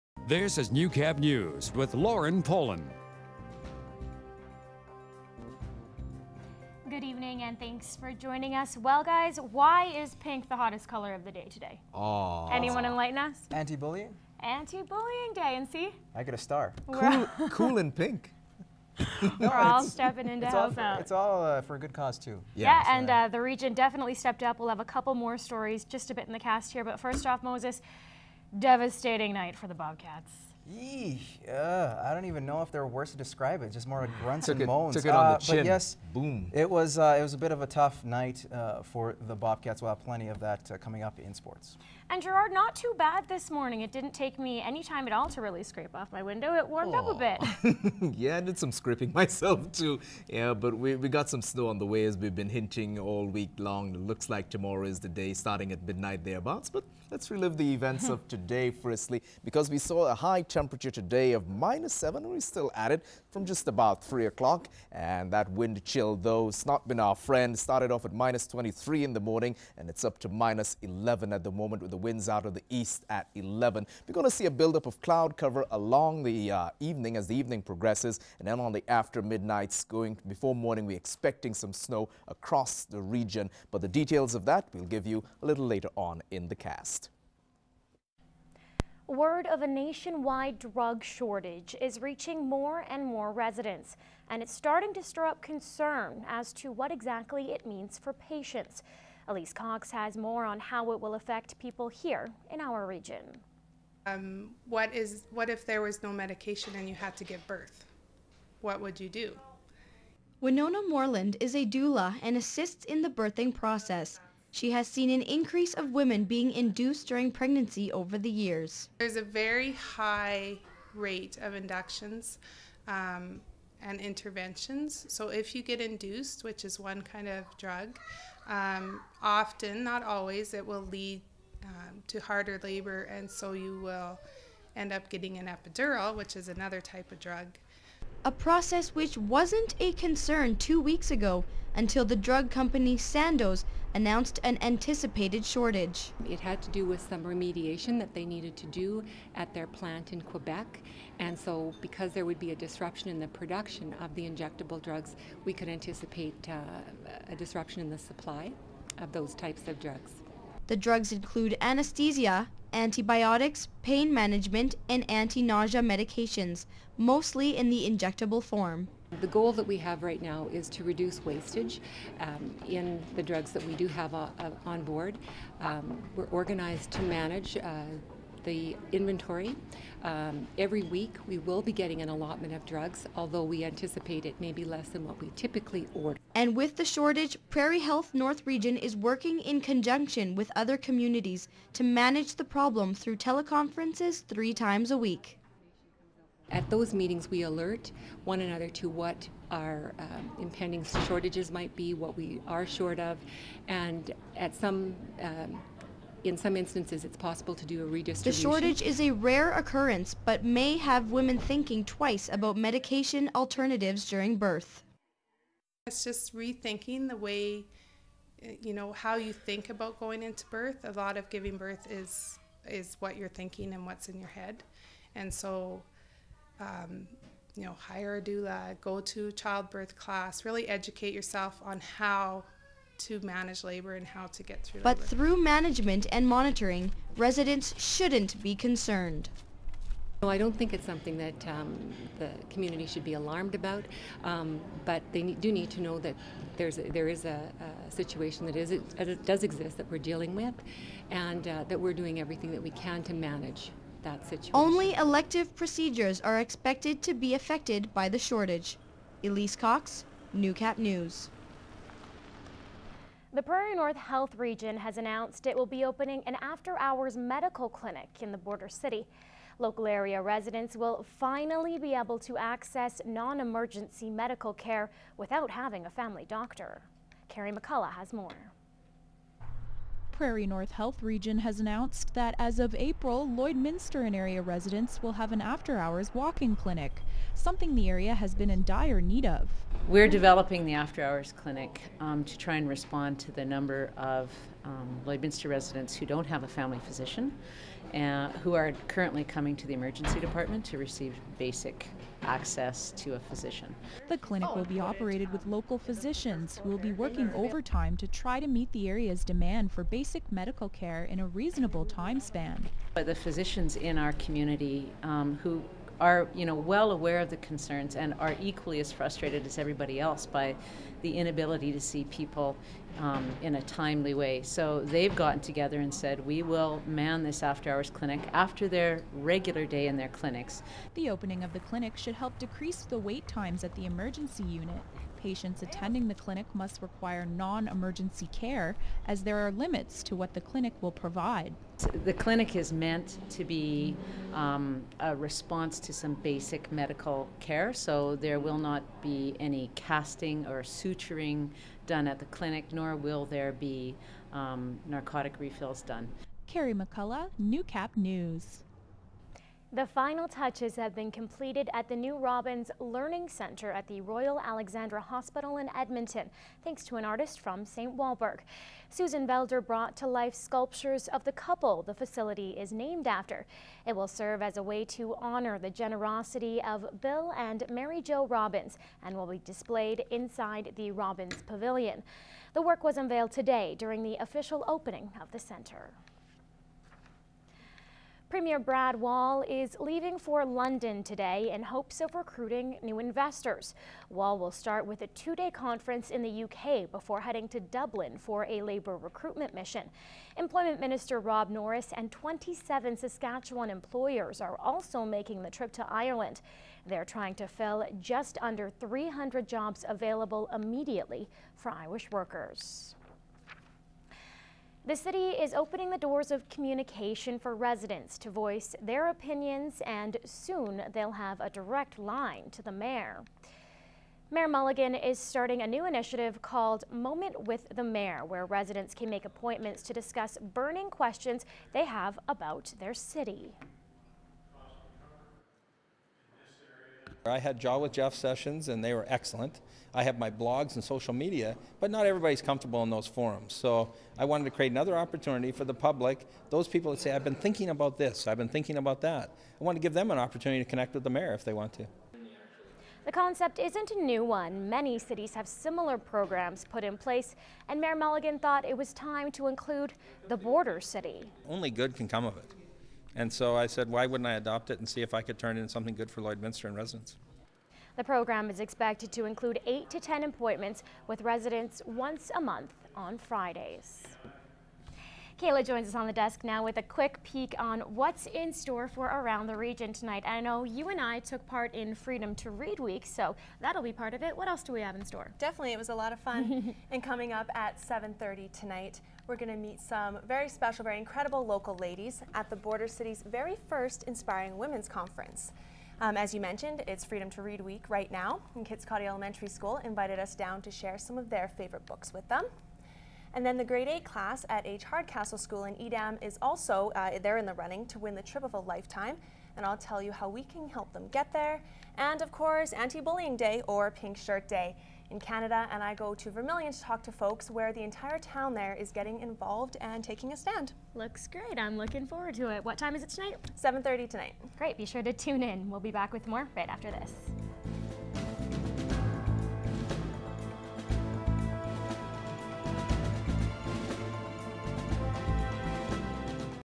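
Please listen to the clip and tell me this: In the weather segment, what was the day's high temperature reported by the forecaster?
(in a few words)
-7.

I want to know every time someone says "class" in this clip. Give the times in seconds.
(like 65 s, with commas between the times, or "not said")
229 s, 504 s.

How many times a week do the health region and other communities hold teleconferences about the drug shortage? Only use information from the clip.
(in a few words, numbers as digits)
3.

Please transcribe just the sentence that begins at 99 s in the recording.
Elise Cox has more on how it will affect people here in our region.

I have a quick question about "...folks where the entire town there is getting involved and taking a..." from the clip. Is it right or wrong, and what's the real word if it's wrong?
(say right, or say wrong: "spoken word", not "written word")
right.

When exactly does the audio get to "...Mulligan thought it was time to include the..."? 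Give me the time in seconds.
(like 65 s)
457 s.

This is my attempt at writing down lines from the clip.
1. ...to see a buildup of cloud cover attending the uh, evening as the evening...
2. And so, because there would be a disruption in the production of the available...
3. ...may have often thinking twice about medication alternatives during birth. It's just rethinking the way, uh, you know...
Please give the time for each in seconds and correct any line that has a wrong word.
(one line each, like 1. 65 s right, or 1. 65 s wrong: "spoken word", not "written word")
1. 74 s wrong: "along", not "attending"
2. 151 s wrong: "injectable", not "available"
3. 210 s wrong: "women", not "often".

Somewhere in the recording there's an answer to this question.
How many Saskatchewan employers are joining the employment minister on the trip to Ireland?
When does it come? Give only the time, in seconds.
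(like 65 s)
402 s.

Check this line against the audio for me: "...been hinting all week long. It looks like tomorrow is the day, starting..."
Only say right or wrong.
right.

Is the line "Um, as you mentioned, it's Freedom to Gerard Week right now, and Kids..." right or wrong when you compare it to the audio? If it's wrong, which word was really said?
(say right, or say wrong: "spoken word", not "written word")
wrong: "Read", not "Gerard".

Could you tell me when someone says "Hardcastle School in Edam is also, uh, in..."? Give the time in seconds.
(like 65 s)
504 s.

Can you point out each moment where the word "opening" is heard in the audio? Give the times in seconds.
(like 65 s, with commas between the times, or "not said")
265 s, 331 s, 384 s, 415 s.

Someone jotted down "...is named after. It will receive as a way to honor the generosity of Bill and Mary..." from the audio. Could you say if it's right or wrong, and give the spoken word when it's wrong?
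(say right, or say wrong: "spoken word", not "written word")
wrong: "serve", not "receive".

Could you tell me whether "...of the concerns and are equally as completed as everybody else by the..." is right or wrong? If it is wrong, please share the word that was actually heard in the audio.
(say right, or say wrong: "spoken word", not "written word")
wrong: "frustrated", not "completed".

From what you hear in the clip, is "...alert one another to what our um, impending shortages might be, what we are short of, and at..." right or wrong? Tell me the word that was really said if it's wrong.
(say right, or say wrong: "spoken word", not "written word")
right.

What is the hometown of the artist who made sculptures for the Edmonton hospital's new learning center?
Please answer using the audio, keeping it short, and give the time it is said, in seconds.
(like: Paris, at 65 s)
St. Walburg, at 367 s.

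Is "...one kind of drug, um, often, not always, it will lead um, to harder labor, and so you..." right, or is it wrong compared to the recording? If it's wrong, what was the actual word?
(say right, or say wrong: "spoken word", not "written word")
right.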